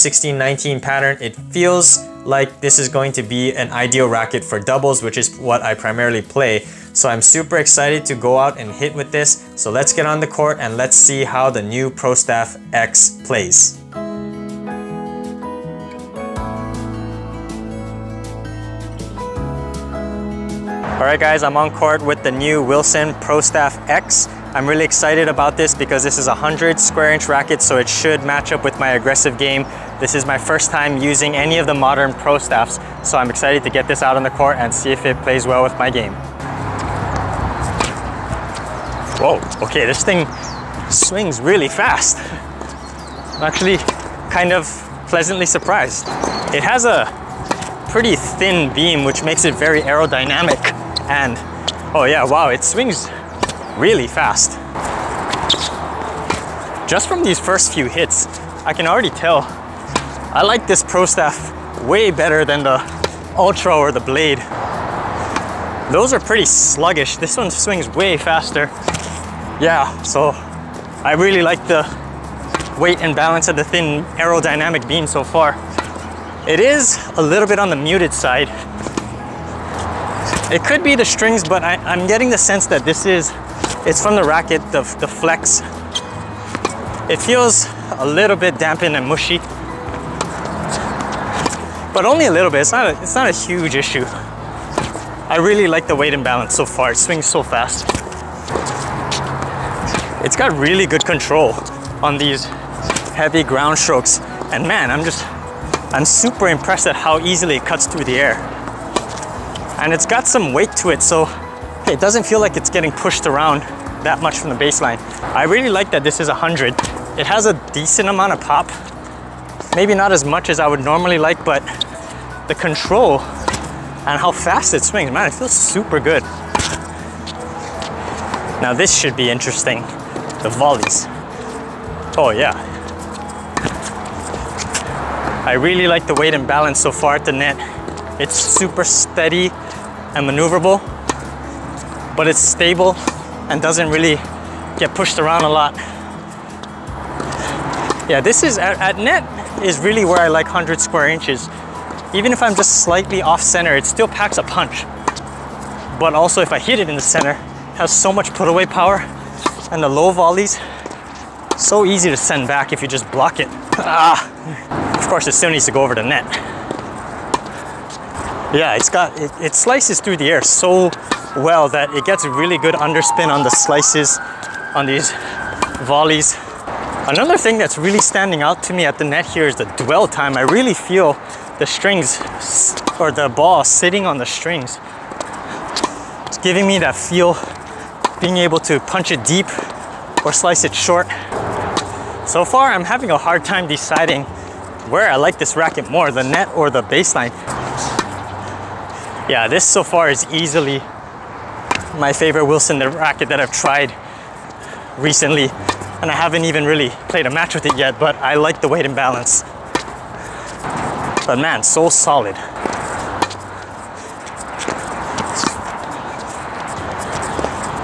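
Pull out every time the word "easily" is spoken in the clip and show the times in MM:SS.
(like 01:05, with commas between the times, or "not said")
01:47, 03:20.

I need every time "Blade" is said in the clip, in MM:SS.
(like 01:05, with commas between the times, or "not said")
01:04.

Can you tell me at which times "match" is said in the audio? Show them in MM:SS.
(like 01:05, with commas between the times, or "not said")
00:28, 03:27.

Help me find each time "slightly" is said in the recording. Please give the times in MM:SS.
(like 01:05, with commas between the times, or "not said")
02:32.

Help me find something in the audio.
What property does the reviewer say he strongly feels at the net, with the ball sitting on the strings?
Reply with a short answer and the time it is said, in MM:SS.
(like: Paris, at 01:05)
dwell time, at 02:59.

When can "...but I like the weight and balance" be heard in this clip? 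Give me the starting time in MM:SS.
03:27.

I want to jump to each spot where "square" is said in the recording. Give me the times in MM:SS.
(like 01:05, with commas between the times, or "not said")
00:26, 02:30.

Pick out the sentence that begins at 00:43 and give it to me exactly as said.
I'm actually kind of pleasantly surprised.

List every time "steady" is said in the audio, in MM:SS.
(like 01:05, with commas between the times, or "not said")
02:18.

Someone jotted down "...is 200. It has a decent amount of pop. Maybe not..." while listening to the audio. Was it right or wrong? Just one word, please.
wrong.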